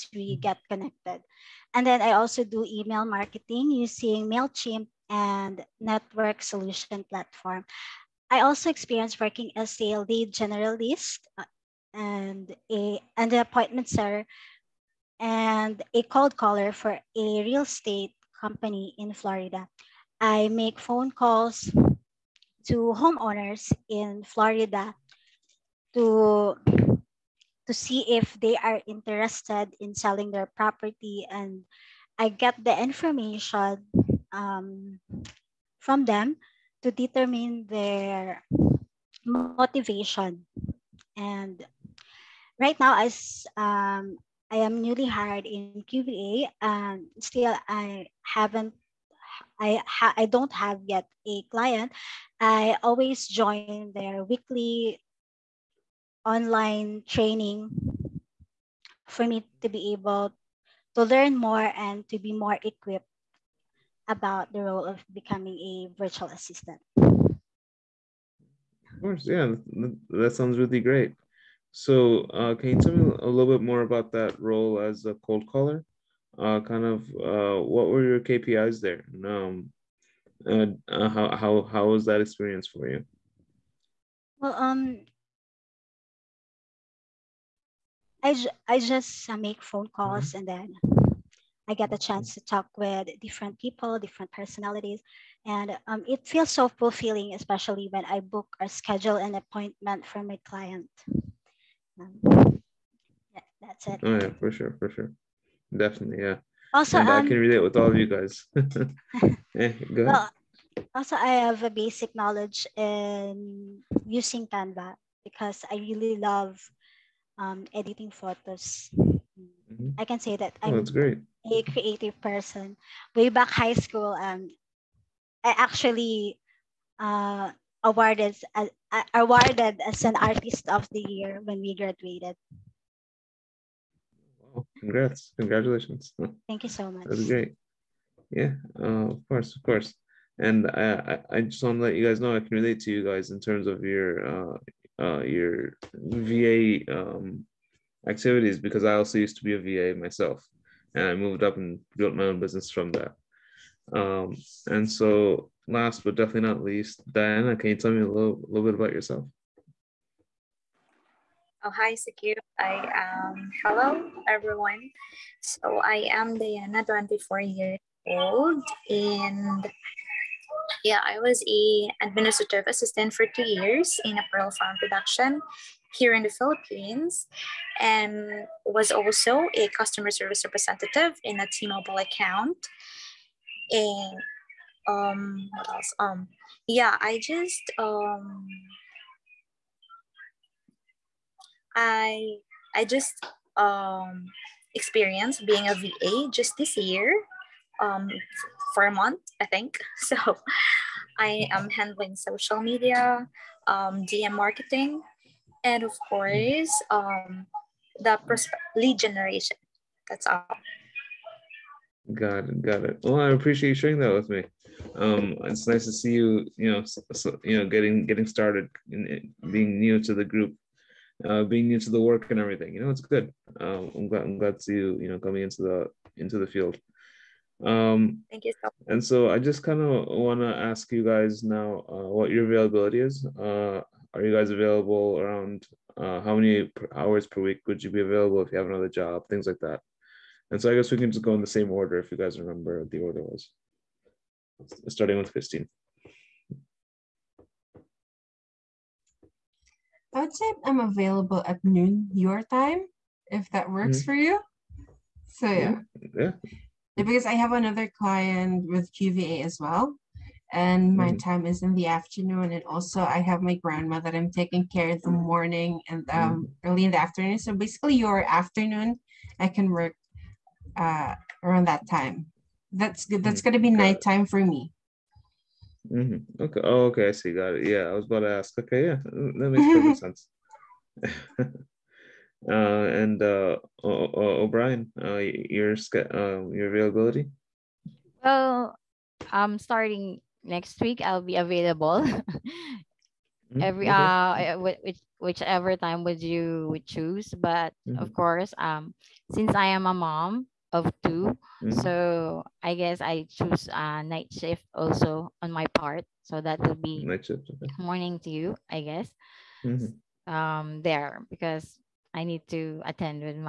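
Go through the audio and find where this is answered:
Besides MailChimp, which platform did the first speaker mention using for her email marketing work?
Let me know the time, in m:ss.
0:05.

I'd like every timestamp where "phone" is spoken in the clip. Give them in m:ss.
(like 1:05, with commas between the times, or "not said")
0:20, 1:29.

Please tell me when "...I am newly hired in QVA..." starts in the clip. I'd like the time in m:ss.
0:44.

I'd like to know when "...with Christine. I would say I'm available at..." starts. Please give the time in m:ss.
4:05.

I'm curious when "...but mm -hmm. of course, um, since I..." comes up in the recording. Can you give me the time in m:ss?
4:57.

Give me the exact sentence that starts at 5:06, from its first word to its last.
So that will be night shift, okay.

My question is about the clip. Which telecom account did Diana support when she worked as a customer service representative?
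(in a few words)
T-Mobile.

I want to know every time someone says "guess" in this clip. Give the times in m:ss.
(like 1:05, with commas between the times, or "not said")
4:00, 5:02, 5:08.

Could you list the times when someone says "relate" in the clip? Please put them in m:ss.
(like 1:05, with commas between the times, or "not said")
1:47, 2:22.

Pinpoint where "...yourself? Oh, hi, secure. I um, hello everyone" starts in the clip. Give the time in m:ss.
2:38.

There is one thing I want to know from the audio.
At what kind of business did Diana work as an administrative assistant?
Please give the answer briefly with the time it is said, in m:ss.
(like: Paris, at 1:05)
Pearl farm, at 2:54.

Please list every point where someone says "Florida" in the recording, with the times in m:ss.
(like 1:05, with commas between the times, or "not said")
0:19, 0:24.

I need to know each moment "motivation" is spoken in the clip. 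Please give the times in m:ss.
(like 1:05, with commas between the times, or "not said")
0:39.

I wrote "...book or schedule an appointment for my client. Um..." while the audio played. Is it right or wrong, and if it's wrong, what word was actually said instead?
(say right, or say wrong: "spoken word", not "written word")
right.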